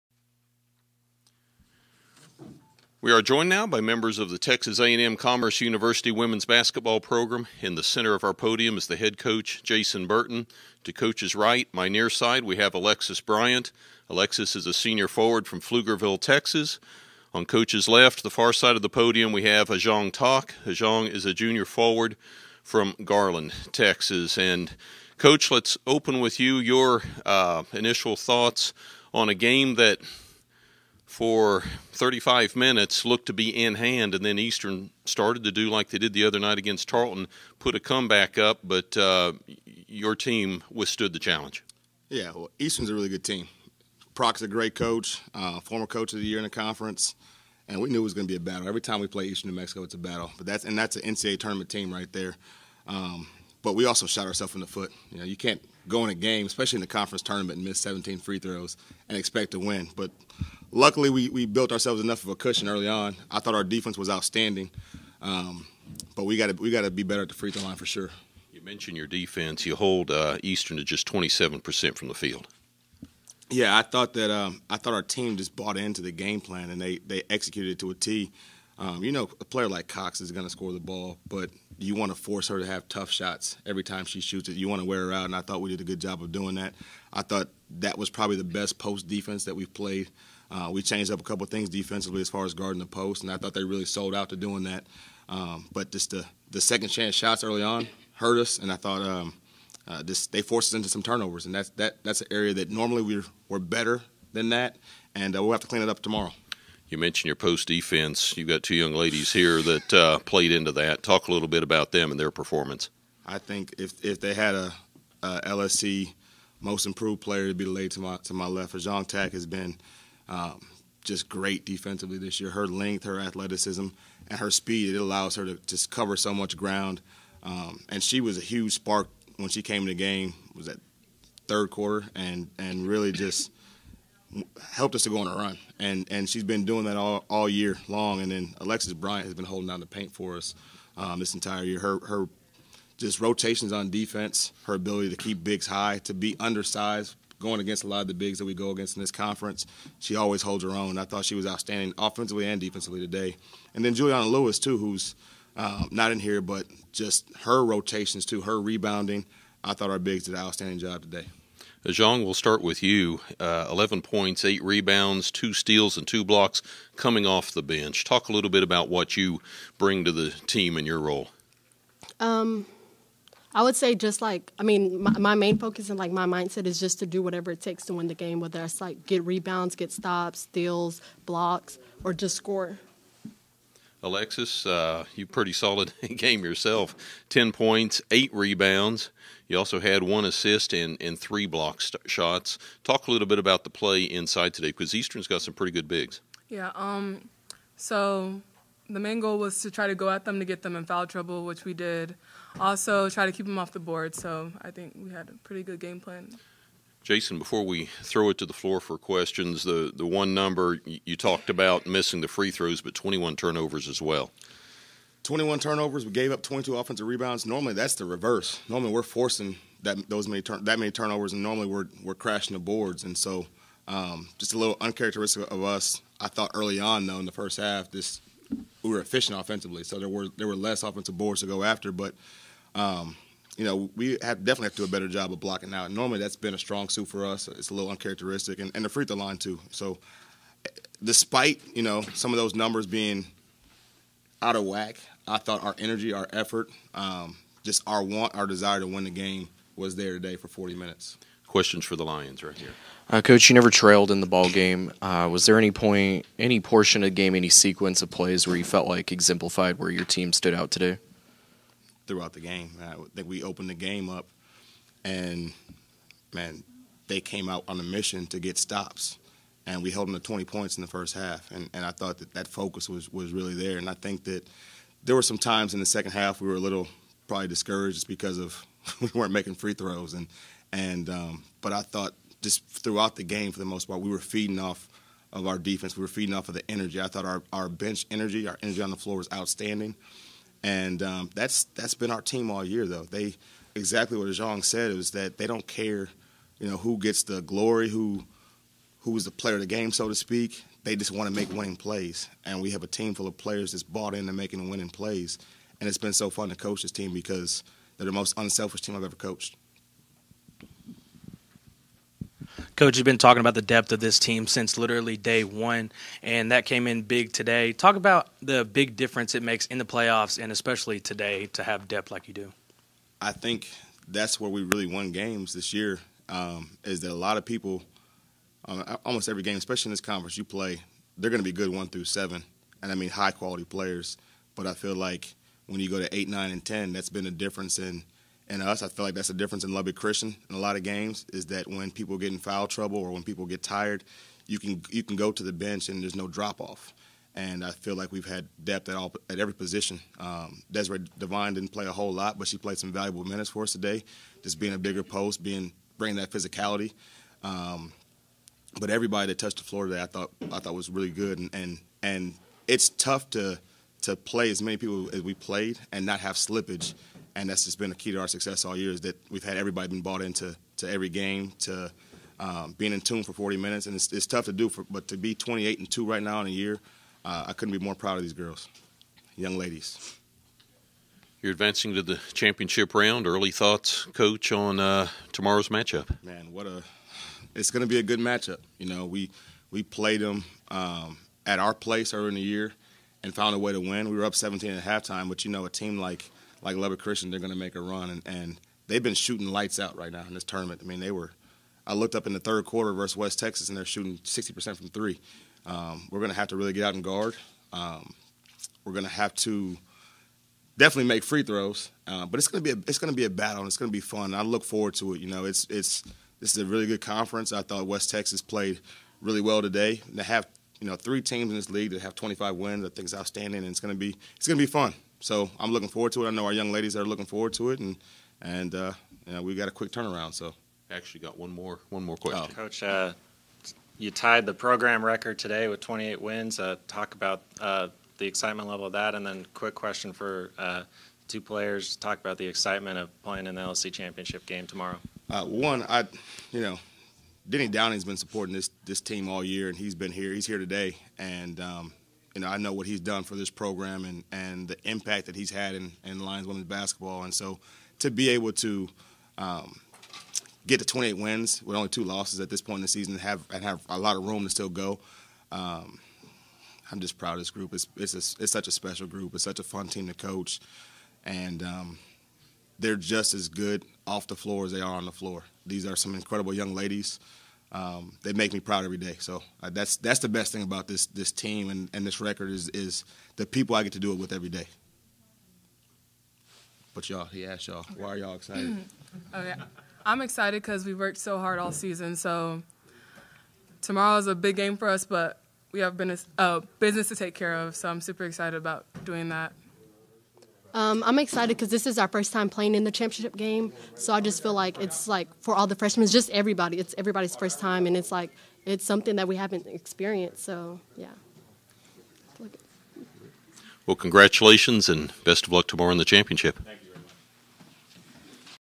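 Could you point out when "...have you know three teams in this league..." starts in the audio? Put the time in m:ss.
7:00.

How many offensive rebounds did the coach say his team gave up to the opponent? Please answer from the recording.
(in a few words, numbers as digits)
22.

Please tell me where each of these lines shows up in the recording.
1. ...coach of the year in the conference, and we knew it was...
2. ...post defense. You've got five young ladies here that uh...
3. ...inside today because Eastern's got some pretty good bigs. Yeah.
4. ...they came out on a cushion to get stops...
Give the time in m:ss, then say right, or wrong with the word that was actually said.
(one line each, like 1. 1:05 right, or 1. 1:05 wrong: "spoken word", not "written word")
1. 0:45 right
2. 1:47 wrong: "two", not "five"
3. 3:14 right
4. 4:27 wrong: "mission", not "cushion".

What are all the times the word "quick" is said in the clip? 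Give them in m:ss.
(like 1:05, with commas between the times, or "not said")
7:09, 7:19.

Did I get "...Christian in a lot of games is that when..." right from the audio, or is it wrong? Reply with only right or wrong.
right.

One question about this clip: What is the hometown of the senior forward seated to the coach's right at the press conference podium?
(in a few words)
Pflugerville, Texas.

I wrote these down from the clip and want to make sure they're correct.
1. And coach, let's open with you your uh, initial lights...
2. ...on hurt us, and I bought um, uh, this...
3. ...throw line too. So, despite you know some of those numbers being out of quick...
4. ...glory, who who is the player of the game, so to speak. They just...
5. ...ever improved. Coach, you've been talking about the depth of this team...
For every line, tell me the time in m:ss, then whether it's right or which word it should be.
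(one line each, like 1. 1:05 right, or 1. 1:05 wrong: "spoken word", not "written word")
1. 0:24 wrong: "thoughts", not "lights"
2. 1:37 wrong: "thought", not "bought"
3. 3:59 wrong: "whack", not "quick"
4. 4:57 right
5. 5:09 wrong: "coached", not "improved".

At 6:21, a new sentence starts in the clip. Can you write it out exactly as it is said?
You're advancing to the championship round.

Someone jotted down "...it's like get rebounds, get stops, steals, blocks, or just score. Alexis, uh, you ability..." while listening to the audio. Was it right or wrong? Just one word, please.
wrong.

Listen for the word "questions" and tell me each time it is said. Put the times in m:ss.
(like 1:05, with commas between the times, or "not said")
3:28, 4:11, 7:12, 7:19.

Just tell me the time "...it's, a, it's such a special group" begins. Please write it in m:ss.
7:47.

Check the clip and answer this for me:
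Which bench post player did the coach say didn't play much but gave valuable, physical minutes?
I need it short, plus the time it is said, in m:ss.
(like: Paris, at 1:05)
Desiree Devine, at 5:50.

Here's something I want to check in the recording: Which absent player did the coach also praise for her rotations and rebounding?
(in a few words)
Juliana Lewis.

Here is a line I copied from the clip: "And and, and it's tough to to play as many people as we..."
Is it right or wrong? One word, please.
right.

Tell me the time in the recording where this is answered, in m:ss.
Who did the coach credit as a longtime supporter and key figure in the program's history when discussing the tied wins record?
7:27.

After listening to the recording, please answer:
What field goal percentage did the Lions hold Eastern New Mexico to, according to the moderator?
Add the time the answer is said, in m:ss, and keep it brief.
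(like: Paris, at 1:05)
27 percent, at 1:11.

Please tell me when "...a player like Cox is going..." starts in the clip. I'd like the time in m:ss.
1:19.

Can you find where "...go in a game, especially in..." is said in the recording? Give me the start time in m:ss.
0:55.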